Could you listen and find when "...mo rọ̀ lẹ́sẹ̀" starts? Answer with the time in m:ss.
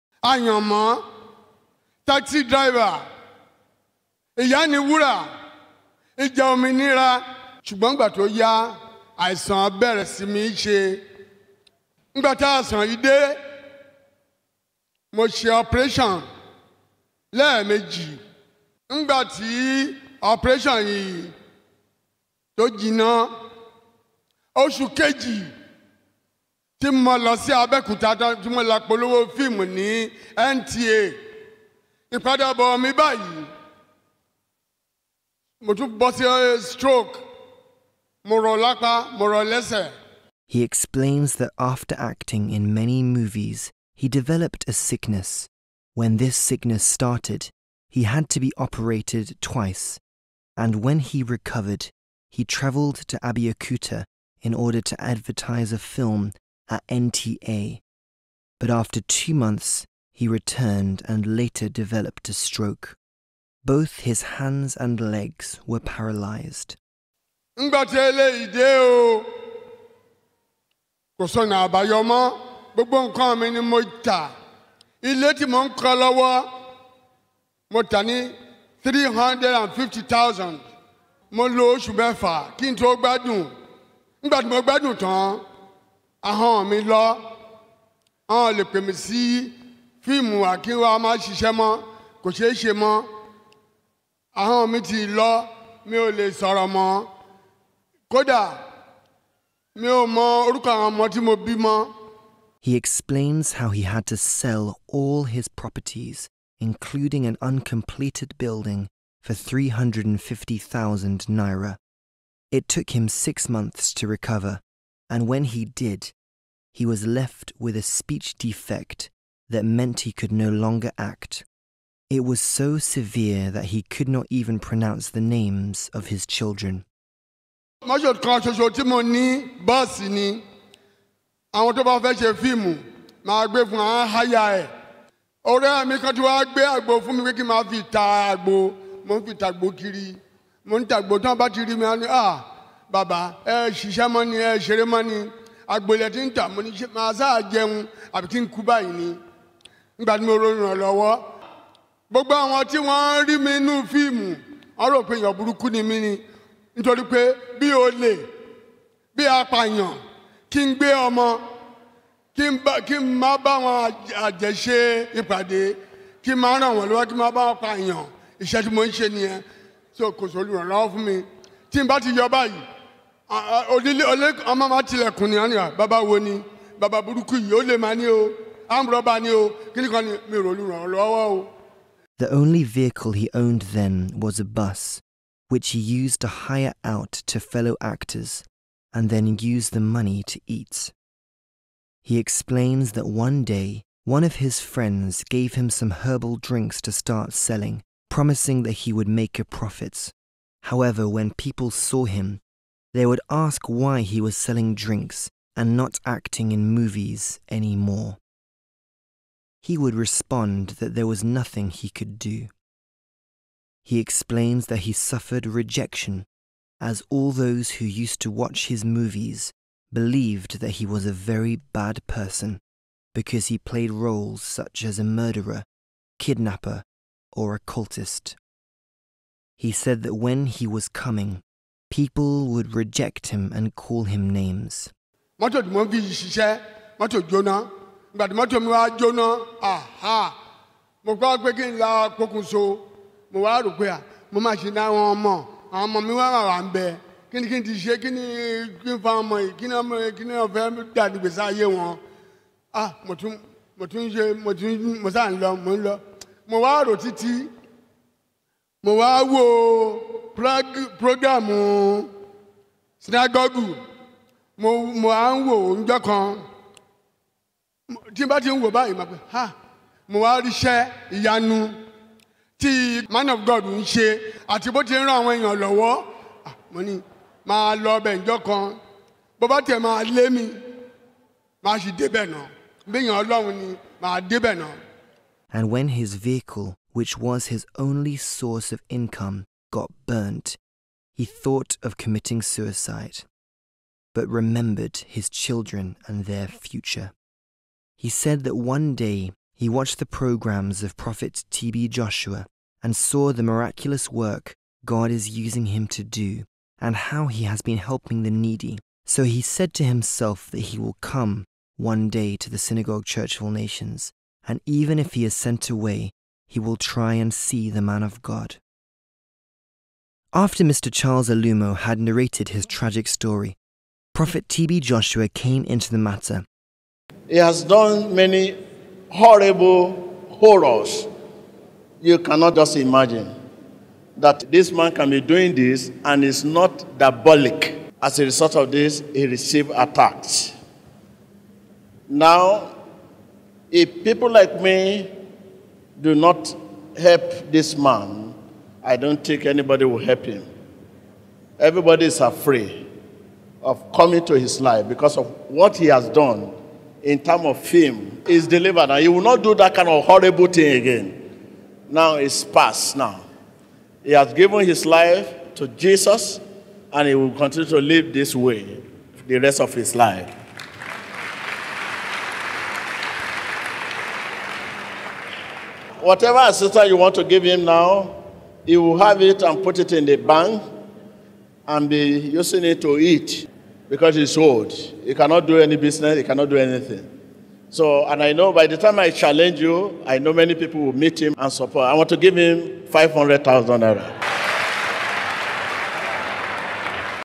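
0:39.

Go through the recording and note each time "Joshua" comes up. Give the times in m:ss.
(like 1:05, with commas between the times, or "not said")
5:01, 5:24.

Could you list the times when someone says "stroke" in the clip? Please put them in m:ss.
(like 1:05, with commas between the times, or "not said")
0:36, 1:02.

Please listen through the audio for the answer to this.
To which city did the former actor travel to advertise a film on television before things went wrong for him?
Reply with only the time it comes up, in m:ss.
0:53.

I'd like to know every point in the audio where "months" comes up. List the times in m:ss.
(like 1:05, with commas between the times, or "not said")
0:59, 1:53.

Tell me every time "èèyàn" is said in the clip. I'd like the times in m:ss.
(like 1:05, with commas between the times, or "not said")
2:35, 4:35.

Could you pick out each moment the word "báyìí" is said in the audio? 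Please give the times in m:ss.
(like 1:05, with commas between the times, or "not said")
2:28, 2:52, 4:28.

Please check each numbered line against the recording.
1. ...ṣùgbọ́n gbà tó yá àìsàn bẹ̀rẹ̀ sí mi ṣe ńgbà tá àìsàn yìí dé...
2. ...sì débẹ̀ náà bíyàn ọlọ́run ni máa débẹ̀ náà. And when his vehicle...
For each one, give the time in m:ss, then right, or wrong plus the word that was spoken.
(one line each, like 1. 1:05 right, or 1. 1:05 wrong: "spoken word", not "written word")
1. 0:07 right
2. 4:41 right.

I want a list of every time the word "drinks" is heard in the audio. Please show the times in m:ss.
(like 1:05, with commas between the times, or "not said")
3:16, 3:24.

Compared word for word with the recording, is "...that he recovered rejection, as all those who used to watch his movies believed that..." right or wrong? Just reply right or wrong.
wrong.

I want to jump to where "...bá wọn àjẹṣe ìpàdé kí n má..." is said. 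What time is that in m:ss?
2:43.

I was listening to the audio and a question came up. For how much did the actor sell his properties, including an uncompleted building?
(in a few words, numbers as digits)
350,000 naira.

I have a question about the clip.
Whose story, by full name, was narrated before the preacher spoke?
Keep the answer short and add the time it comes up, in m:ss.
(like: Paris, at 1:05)
Charles Alumo, at 5:20.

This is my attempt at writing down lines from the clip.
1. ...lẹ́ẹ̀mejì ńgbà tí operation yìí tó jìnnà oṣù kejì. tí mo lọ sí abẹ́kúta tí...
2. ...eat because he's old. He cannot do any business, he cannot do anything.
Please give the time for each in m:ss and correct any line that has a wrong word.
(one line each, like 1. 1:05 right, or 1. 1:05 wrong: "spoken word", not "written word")
1. 0:17 right
2. 6:22 right.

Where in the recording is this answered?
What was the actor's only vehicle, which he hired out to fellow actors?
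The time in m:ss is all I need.
3:04.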